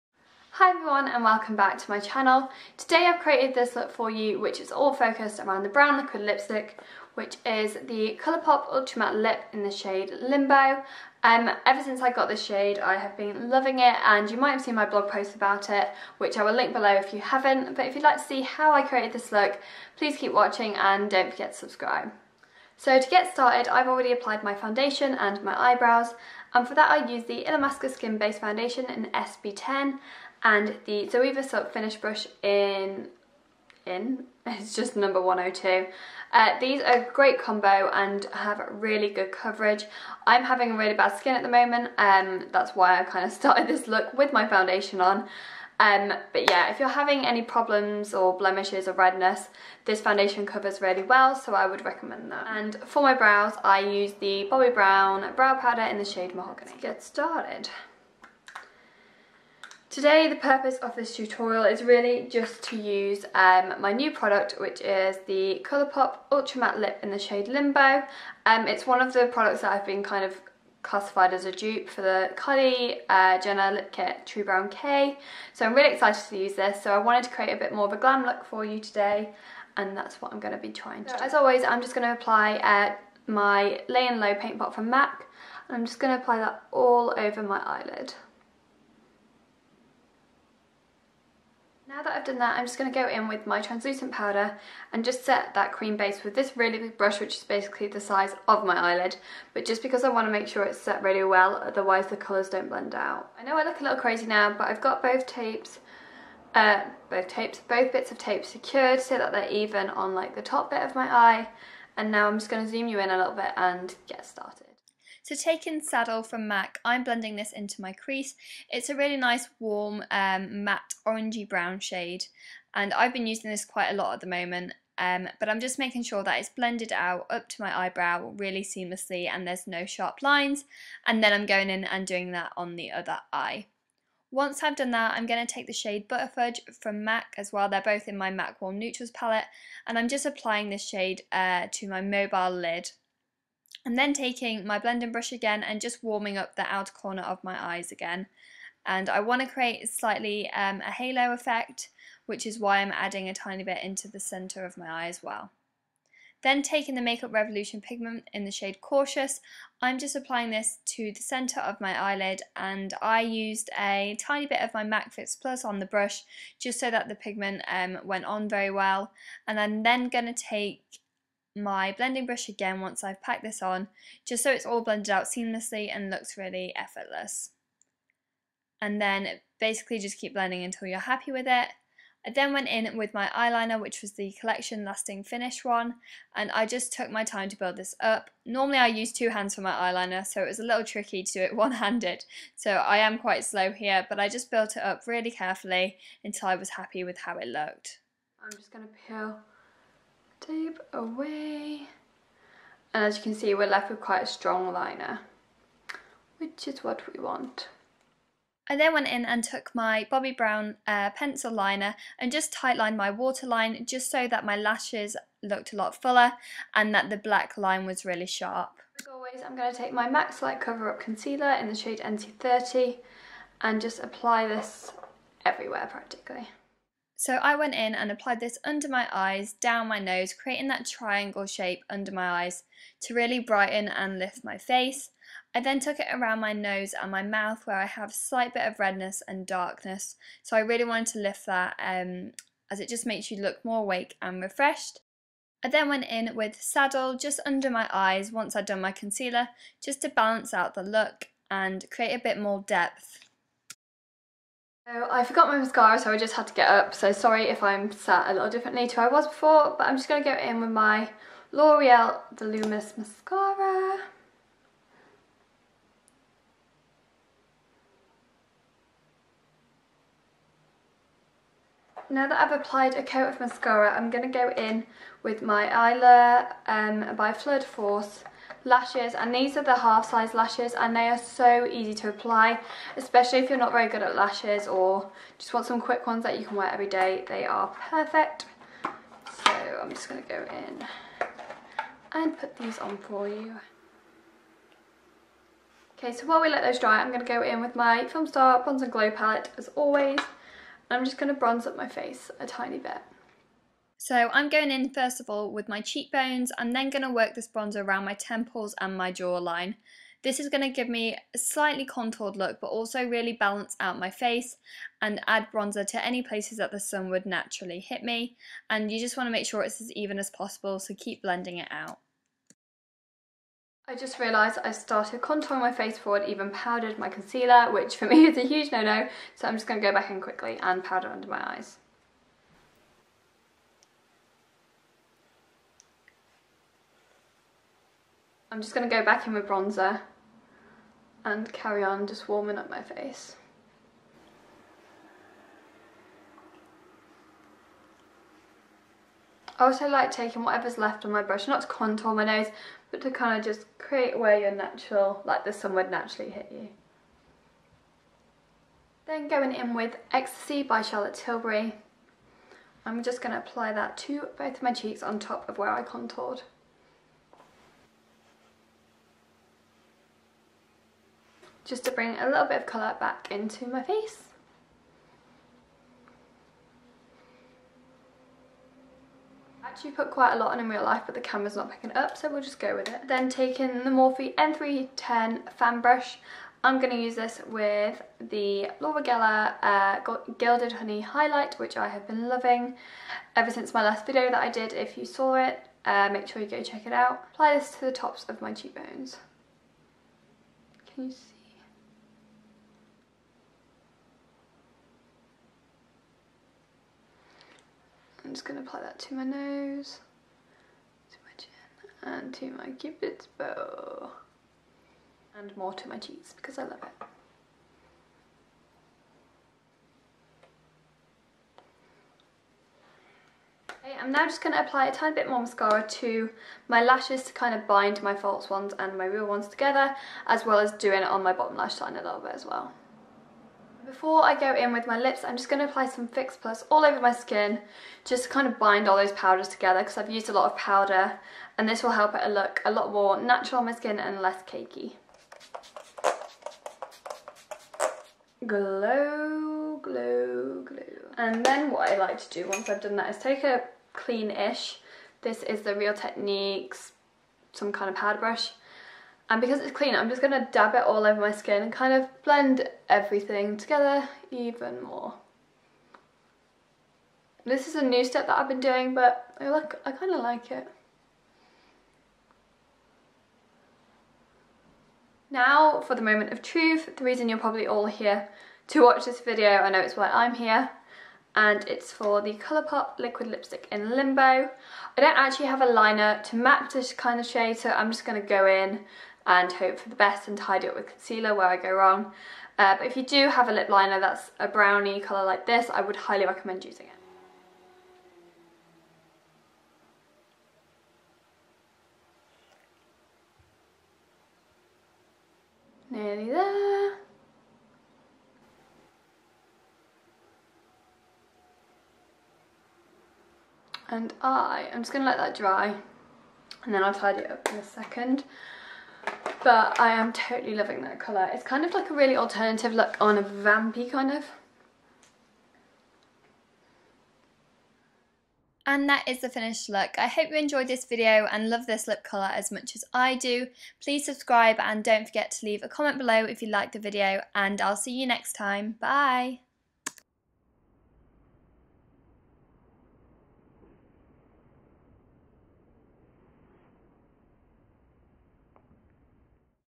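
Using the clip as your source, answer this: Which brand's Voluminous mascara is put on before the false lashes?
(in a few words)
L'Oreal.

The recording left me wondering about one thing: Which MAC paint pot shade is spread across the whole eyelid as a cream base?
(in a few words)
Layin' Low.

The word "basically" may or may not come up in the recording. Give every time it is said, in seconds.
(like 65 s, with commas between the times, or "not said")
97 s, 179 s.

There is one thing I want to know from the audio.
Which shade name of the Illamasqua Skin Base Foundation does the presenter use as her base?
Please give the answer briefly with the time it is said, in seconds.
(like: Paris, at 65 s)
SB10, at 29 s.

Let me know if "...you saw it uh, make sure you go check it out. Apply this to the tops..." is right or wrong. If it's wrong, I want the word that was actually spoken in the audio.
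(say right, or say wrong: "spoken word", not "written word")
right.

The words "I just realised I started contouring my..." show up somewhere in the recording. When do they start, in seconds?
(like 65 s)
323 s.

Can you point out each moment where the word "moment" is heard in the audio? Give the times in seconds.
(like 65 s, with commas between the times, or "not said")
41 s, 124 s, 476 s.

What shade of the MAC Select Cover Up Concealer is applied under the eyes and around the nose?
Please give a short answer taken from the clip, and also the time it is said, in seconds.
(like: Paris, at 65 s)
NC30, at 221 s.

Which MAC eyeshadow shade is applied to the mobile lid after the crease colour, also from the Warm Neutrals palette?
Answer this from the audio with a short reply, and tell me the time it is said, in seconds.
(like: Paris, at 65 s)
Butterfudge, at 136 s.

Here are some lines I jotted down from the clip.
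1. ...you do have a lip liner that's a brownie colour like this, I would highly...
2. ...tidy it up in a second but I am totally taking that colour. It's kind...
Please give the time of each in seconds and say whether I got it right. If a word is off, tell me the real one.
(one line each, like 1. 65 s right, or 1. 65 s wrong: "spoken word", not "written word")
1. 492 s right
2. 516 s wrong: "loving", not "taking".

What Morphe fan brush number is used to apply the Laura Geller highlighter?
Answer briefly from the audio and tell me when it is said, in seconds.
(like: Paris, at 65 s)
N310, at 384 s.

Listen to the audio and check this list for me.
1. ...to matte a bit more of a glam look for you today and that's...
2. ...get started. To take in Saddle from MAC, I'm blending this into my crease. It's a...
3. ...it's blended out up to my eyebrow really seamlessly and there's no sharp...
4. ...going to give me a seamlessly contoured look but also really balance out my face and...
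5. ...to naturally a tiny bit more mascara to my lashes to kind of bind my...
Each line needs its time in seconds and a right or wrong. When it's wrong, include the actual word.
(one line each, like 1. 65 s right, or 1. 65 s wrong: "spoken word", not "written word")
1. 77 s wrong: "create", not "matte"
2. 114 s right
3. 126 s right
4. 310 s wrong: "slightly", not "seamlessly"
5. 424 s wrong: "apply", not "naturally".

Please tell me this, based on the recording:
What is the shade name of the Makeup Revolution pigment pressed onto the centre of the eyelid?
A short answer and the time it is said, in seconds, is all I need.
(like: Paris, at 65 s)
Cautious, at 158 s.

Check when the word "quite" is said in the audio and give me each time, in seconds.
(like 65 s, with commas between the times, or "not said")
123 s, 193 s, 204 s, 380 s.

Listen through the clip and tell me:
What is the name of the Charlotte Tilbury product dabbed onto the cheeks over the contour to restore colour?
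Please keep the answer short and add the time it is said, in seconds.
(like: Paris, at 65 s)
Ecstasy, at 360 s.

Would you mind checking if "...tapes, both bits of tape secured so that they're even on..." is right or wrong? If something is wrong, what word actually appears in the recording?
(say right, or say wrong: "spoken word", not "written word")
right.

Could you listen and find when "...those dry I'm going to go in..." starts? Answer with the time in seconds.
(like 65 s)
296 s.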